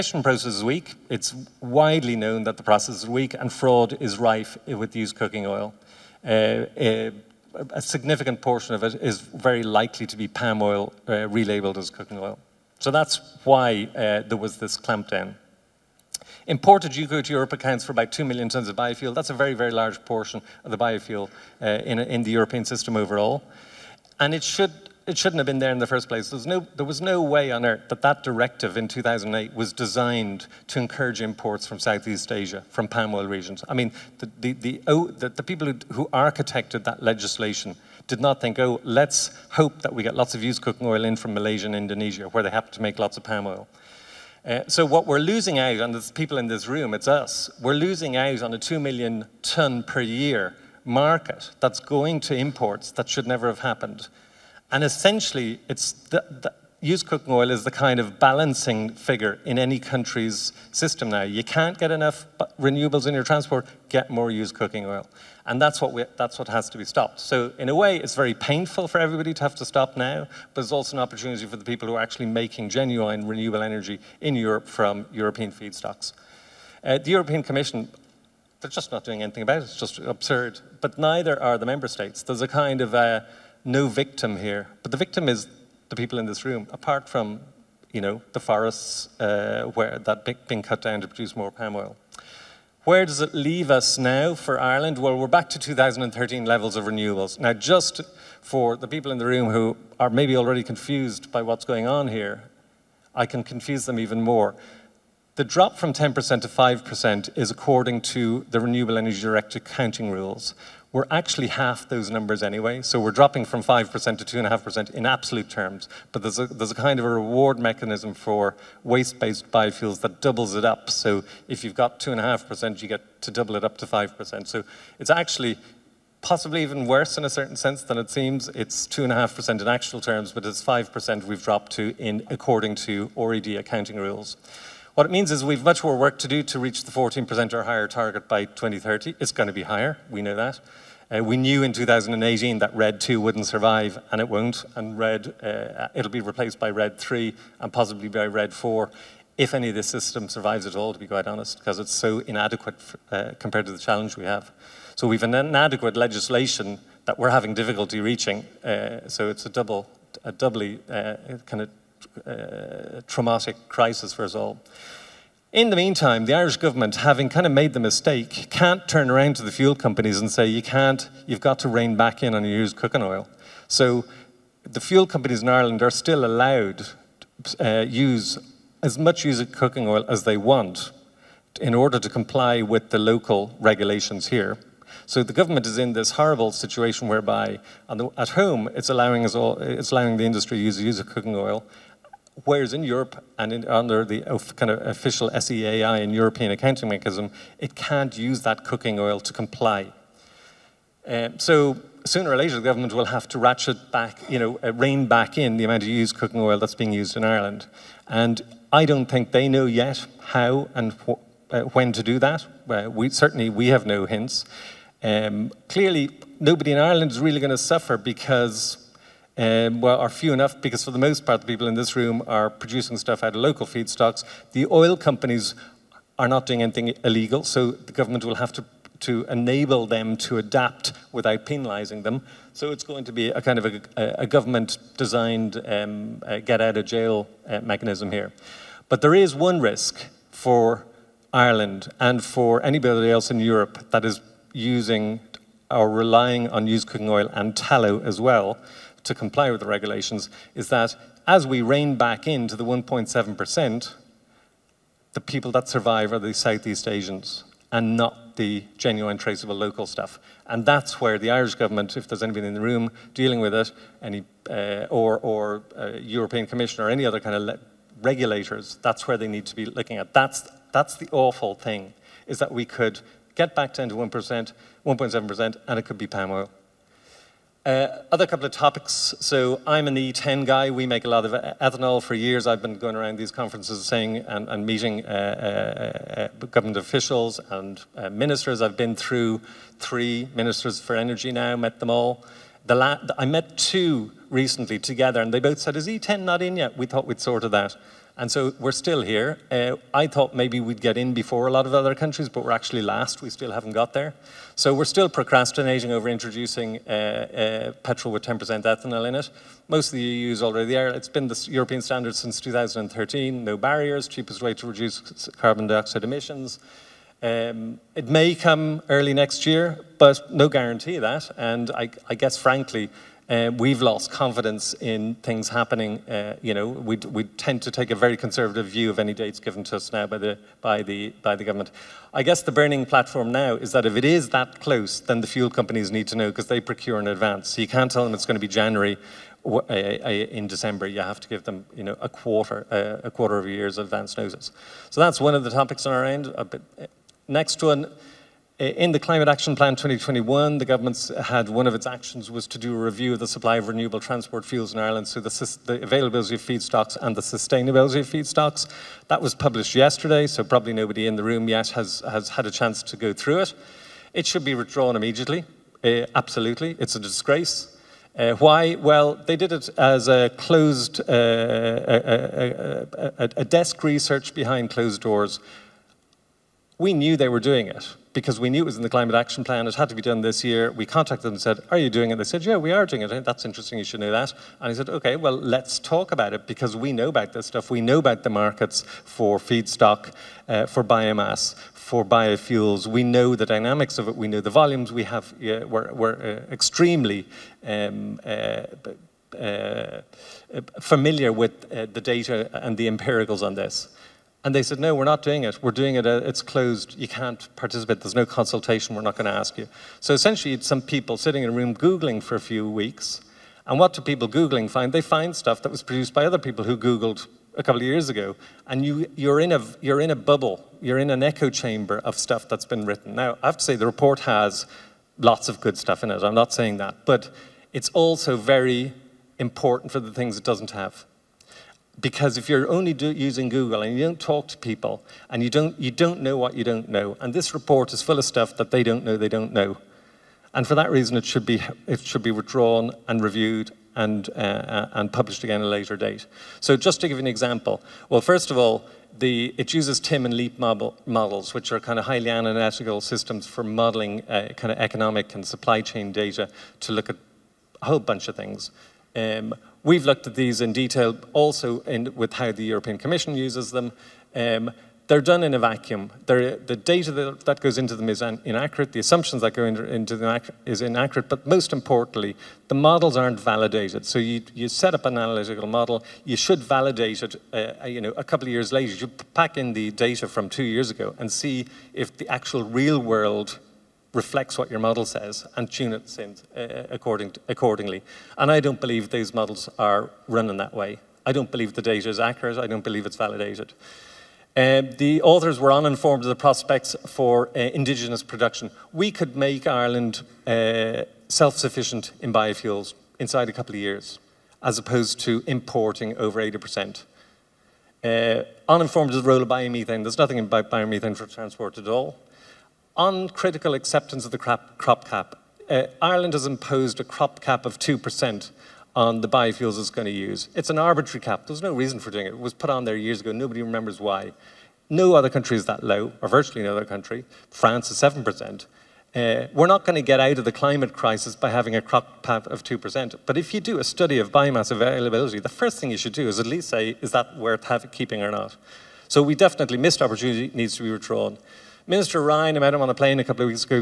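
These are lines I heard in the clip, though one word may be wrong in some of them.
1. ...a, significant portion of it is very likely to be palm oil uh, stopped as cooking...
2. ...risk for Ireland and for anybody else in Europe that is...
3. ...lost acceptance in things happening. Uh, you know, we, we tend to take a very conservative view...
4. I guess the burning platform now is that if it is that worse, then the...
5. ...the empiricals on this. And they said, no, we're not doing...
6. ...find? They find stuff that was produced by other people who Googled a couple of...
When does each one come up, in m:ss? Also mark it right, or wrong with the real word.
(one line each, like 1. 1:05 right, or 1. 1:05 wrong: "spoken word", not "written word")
1. 0:07 wrong: "relabeled", not "stopped"
2. 3:59 right
3. 5:23 wrong: "confidence", not "acceptance"
4. 5:32 wrong: "close", not "worse"
5. 6:42 right
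6. 6:54 right.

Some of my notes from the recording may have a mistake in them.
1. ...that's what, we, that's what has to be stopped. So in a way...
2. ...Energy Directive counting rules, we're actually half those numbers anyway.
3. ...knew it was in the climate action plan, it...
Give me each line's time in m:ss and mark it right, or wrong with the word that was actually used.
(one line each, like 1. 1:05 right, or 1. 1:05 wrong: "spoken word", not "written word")
1. 1:05 right
2. 1:48 right
3. 6:18 right.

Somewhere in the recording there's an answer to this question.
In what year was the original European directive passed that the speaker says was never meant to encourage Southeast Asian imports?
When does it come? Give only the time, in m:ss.
0:28.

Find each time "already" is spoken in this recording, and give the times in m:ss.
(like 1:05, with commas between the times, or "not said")
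1:40, 5:10.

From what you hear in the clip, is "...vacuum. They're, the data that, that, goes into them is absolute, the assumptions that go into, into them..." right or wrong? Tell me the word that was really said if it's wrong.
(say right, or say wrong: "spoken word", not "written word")
wrong: "inaccurate", not "absolute".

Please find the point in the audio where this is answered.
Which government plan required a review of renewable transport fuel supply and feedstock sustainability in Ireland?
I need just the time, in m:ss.
5:48.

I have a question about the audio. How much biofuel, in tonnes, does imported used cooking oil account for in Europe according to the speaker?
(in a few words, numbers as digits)
2 million tons.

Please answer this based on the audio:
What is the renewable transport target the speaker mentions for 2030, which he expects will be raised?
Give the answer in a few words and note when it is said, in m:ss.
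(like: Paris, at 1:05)
14%, at 2:16.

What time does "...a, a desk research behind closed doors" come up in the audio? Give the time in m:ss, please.
6:13.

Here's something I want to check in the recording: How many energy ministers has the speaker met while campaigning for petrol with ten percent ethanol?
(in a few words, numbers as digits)
three.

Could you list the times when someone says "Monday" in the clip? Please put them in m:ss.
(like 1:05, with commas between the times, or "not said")
not said.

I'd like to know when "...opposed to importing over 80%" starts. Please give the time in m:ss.
8:24.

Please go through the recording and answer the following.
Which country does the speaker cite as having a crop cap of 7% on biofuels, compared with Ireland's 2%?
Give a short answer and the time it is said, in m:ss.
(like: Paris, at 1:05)
France, at 8:47.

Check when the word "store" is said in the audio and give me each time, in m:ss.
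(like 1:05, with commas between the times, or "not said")
not said.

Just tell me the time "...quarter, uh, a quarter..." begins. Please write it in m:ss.
5:42.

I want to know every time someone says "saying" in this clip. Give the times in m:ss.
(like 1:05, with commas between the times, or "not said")
4:43, 7:06.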